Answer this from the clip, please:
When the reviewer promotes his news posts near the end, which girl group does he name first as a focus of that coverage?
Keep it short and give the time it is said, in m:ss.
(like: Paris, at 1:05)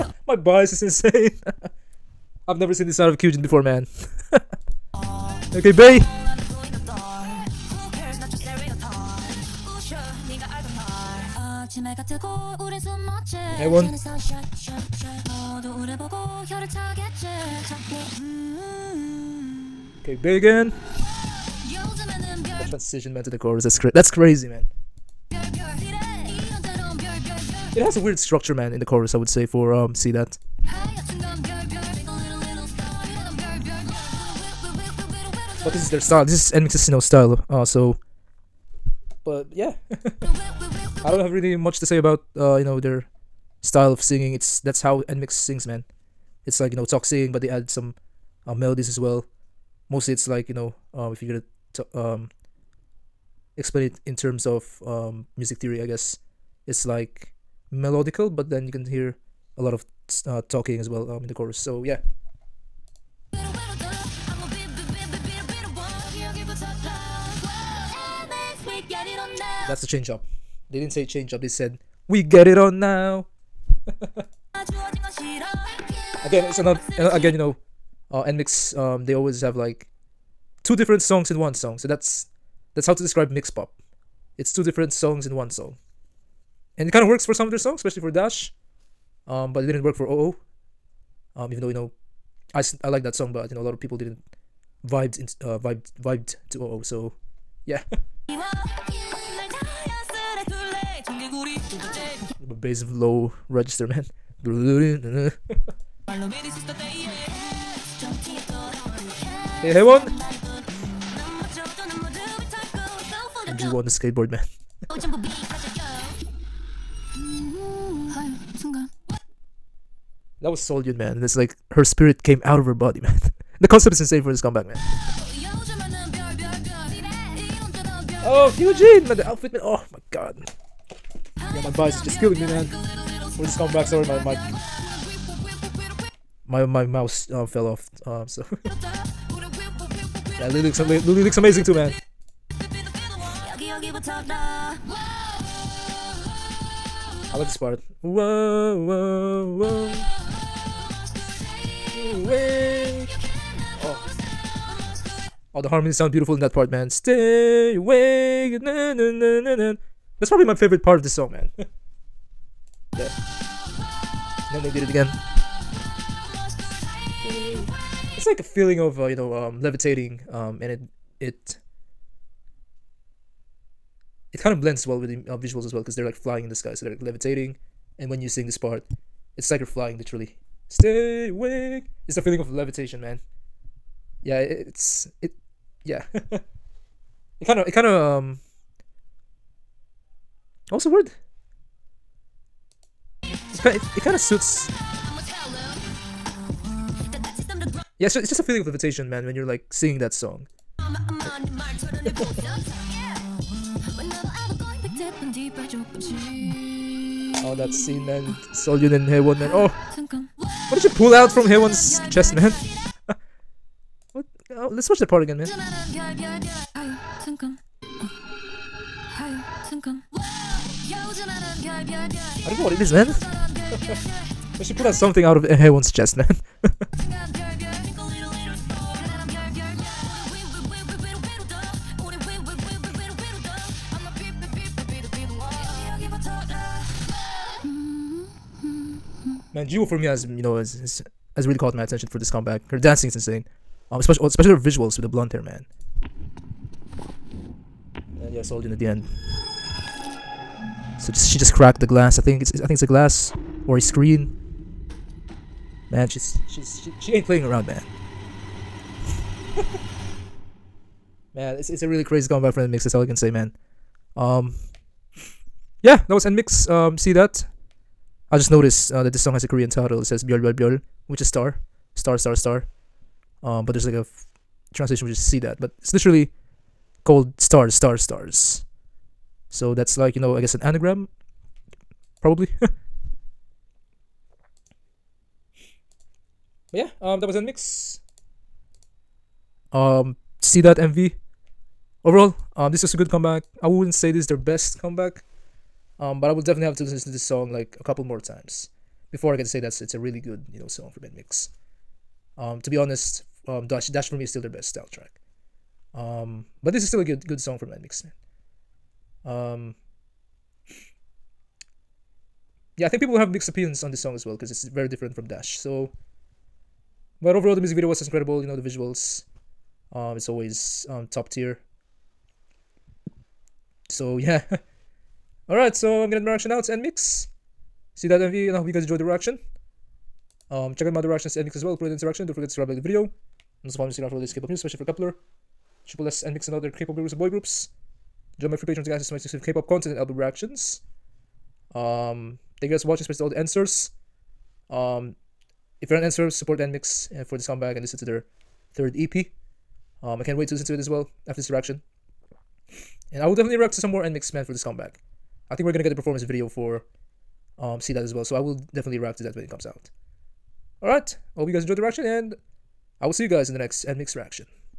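Kep1er, at 5:34.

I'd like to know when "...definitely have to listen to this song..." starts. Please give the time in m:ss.
4:56.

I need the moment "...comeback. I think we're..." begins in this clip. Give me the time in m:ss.
5:54.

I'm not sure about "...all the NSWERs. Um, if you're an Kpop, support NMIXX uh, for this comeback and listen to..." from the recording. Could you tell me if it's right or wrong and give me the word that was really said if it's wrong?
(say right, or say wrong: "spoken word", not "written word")
wrong: "NSWER", not "Kpop".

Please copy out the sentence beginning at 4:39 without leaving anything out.
So that's like you know, I guess an anagram, probably.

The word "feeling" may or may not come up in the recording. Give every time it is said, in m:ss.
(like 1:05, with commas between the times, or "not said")
2:48, 3:02, 3:18.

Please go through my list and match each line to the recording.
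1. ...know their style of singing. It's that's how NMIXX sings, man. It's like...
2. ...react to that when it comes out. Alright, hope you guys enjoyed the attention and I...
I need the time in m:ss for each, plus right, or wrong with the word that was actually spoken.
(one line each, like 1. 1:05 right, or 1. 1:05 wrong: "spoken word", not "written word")
1. 0:42 right
2. 5:58 wrong: "reaction", not "attention".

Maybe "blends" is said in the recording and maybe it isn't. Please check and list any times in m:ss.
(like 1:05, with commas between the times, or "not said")
2:54.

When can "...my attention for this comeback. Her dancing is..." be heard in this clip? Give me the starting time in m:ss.
4:01.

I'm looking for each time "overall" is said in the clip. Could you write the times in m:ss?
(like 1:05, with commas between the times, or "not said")
4:52, 5:17.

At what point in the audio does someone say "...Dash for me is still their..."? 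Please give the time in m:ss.
5:03.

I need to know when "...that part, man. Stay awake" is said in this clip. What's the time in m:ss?
2:36.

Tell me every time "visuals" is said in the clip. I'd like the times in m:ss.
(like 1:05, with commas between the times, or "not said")
2:55, 4:04, 5:18.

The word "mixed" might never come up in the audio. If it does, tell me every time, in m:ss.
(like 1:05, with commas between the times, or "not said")
5:13.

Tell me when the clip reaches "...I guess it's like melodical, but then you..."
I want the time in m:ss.
0:55.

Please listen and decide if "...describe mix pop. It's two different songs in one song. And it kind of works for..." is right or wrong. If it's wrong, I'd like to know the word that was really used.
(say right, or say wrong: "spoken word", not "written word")
right.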